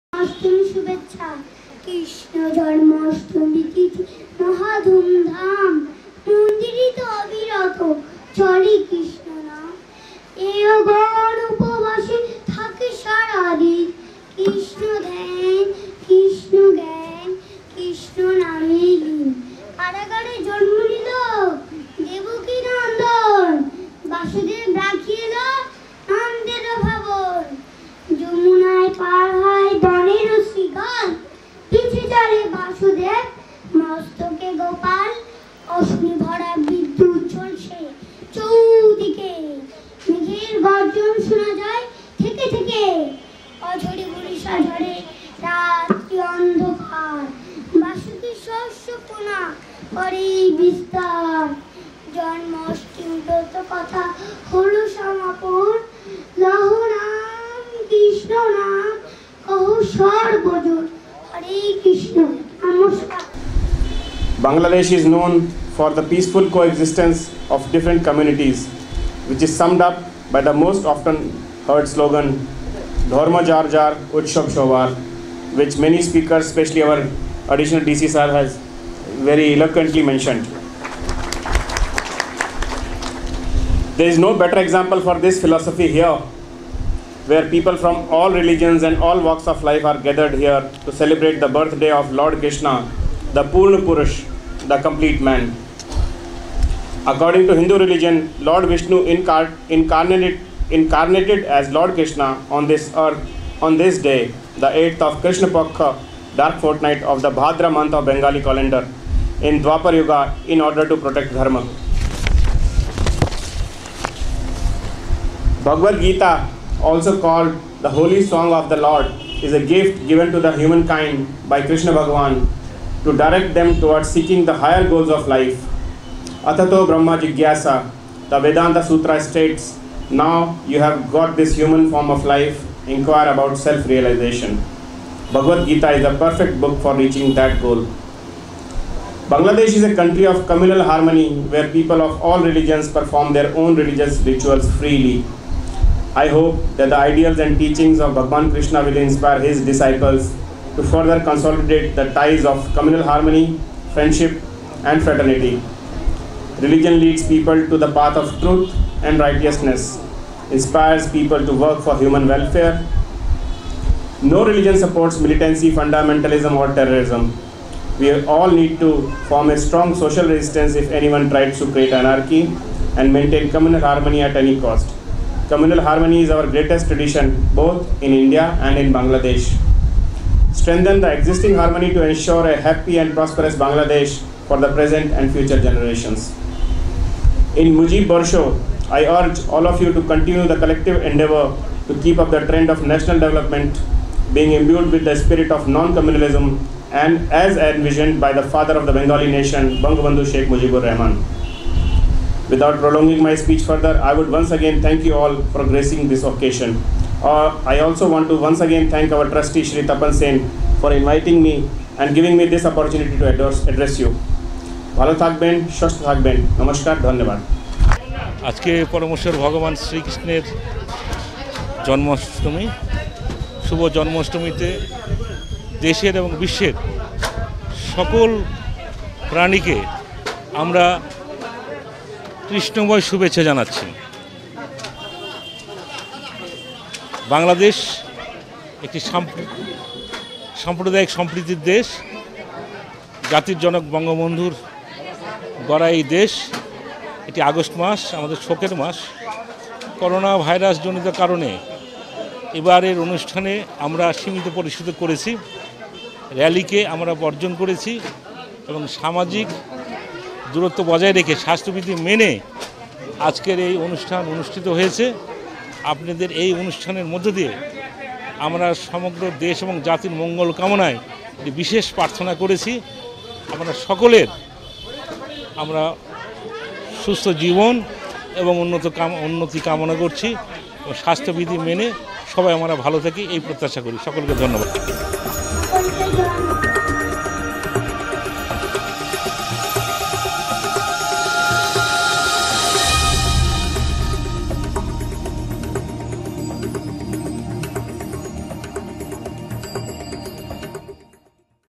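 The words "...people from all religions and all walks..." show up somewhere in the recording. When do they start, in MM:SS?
01:27.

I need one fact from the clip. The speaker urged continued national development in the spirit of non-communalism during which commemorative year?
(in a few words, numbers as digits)
Mujib Borsho.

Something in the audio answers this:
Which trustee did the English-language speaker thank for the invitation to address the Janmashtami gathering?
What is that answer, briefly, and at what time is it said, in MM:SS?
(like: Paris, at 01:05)
Shri Tapan Sen, at 03:29.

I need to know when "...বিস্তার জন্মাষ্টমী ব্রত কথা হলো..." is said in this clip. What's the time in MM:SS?
00:50.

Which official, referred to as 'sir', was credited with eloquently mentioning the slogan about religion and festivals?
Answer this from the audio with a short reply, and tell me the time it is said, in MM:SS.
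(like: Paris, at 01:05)
additional DC, at 01:17.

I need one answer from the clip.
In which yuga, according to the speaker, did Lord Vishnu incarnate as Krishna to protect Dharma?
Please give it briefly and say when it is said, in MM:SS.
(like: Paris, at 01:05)
Dwapar Yuga, at 01:49.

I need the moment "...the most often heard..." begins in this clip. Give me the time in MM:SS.
01:10.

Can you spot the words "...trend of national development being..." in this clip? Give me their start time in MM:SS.
03:12.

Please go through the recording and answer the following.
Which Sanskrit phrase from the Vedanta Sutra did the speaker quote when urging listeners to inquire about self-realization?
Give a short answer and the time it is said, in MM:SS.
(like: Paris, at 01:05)
Atato Brahma Jigyasa, at 02:06.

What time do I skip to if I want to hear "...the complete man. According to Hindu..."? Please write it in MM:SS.
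01:34.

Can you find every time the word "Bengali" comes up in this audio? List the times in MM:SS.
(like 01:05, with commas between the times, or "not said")
01:48, 03:18.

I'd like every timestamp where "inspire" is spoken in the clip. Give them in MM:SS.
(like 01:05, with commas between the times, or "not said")
02:28, 02:40.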